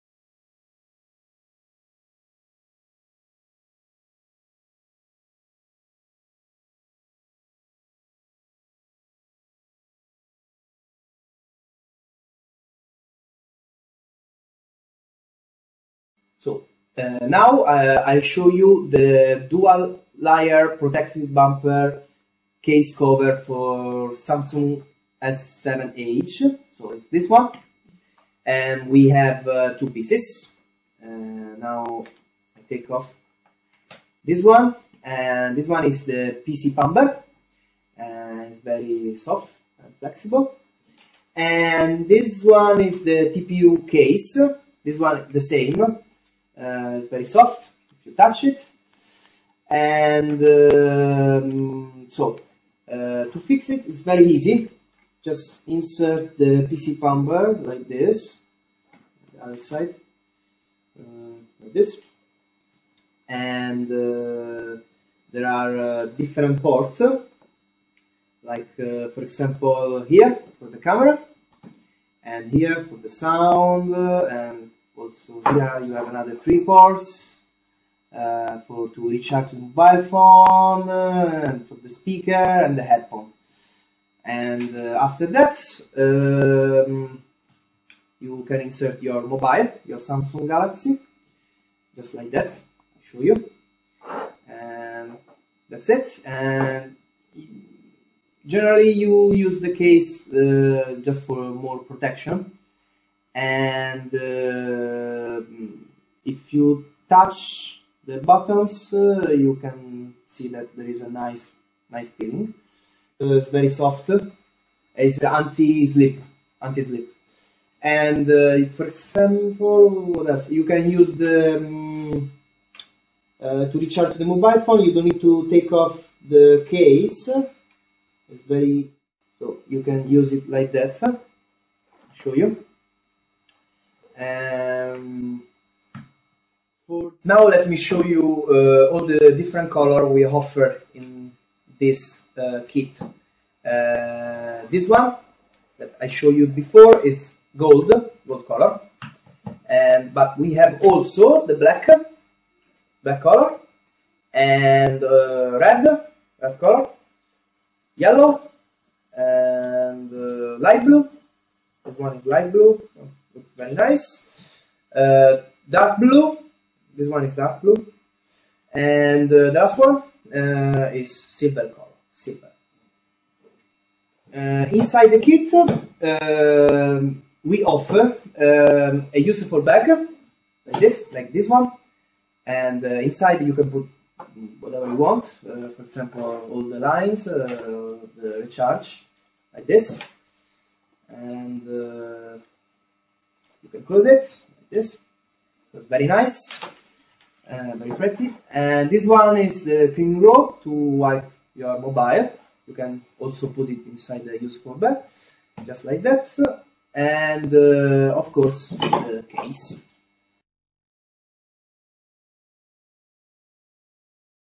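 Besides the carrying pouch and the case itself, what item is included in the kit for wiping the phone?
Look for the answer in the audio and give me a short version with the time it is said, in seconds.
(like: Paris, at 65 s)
Clean rope, at 199 s.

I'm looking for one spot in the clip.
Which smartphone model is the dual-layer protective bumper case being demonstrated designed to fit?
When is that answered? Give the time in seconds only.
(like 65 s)
24 s.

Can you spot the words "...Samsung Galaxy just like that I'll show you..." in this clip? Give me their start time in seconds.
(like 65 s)
89 s.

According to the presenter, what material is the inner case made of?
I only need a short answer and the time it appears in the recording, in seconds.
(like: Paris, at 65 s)
TPU, at 43 s.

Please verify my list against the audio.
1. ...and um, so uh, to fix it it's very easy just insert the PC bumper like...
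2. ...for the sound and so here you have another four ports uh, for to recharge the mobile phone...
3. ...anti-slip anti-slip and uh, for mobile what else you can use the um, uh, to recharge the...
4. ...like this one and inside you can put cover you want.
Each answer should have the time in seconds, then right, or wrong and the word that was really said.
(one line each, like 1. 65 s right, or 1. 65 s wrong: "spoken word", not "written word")
1. 49 s right
2. 72 s wrong: "three", not "four"
3. 115 s wrong: "example", not "mobile"
4. 181 s wrong: "whatever", not "cover".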